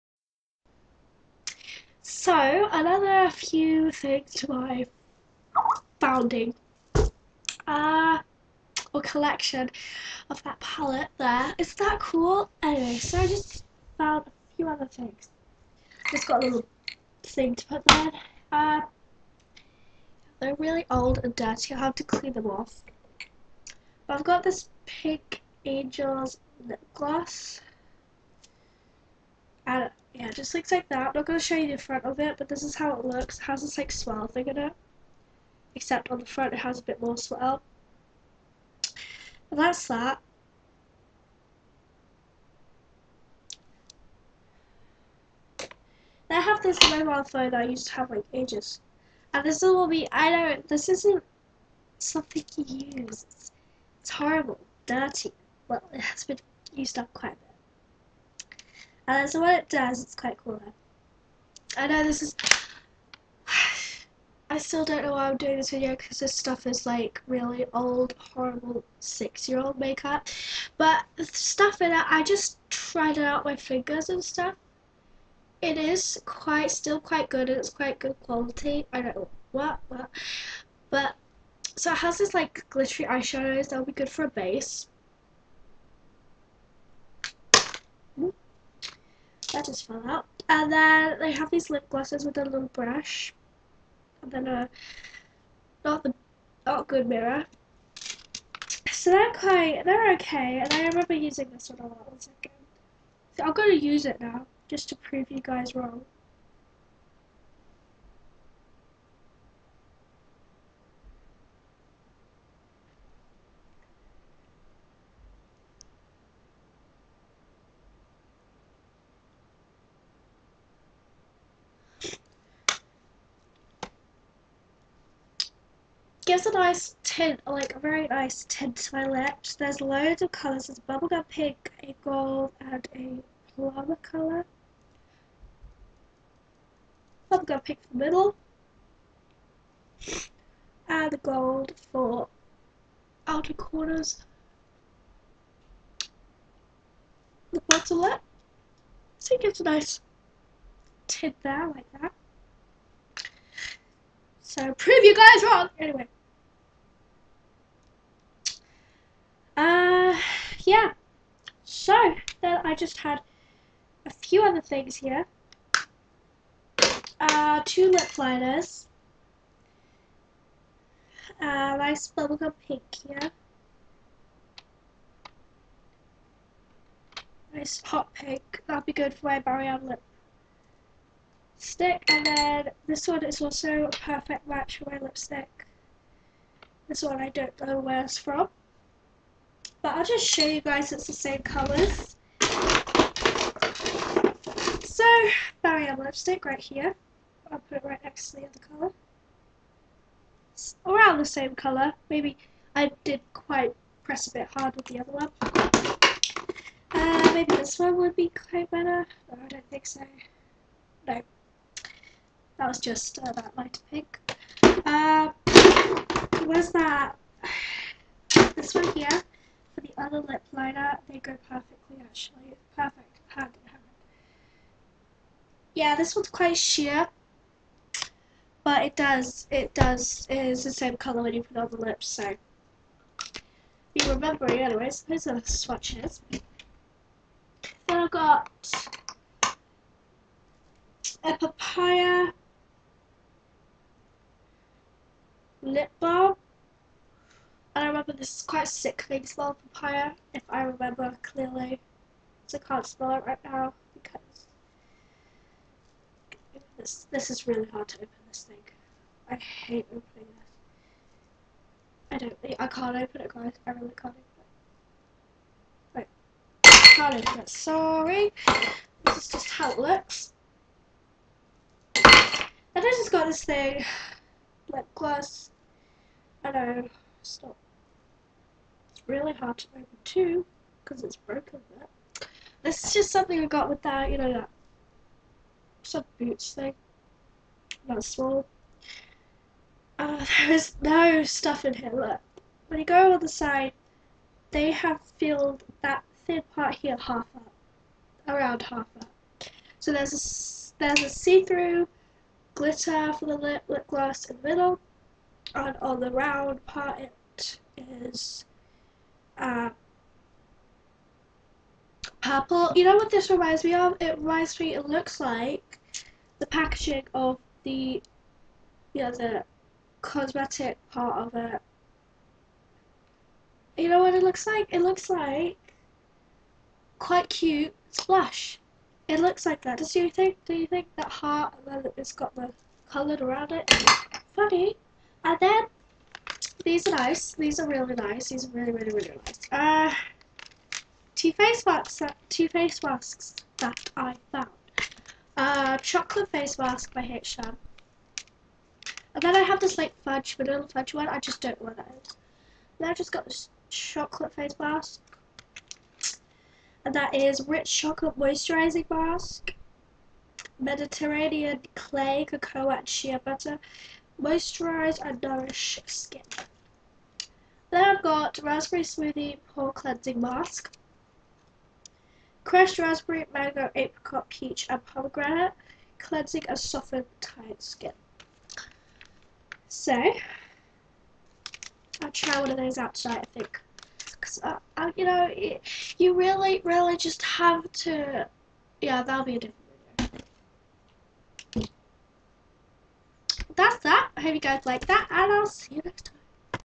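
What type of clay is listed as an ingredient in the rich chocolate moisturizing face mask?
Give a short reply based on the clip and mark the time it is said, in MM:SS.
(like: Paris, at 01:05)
Mediterranean clay, at 06:00.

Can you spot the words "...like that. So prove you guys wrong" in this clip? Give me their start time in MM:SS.
02:31.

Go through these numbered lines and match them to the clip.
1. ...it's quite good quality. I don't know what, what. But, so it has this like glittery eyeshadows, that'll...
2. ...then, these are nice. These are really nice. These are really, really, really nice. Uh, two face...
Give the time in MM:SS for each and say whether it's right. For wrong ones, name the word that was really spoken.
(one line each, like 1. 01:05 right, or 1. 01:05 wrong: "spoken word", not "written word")
1. 01:17 right
2. 05:35 right.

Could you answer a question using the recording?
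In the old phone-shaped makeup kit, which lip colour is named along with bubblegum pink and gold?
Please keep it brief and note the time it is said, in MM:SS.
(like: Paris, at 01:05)
Plum, at 02:13.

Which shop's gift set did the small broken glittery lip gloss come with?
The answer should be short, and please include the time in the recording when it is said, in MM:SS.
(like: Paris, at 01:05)
Boots, at 04:46.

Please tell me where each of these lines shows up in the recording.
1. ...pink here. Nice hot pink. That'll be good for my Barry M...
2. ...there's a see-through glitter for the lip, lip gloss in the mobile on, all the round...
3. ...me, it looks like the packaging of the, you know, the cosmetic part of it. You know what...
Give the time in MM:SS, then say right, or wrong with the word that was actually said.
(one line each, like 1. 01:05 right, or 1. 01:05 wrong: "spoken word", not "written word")
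1. 02:52 right
2. 05:00 wrong: "middle", not "mobile"
3. 05:14 right.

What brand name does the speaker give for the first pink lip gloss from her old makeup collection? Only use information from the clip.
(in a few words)
Angel's.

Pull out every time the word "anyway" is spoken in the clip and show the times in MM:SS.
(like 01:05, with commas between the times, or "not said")
00:12, 02:35, 03:54.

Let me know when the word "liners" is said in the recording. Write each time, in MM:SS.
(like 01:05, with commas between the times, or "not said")
02:48, 03:40.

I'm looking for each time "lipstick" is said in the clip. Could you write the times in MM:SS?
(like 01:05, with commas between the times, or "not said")
03:04, 03:15.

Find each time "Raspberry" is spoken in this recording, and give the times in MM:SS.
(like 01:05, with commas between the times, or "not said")
06:08, 06:12.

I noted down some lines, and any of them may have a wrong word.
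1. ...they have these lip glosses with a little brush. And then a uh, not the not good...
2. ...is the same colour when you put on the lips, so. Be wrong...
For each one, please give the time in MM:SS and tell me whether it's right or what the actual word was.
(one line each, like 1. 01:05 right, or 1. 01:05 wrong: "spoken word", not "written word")
1. 01:31 right
2. 03:50 wrong: "remembering", not "wrong".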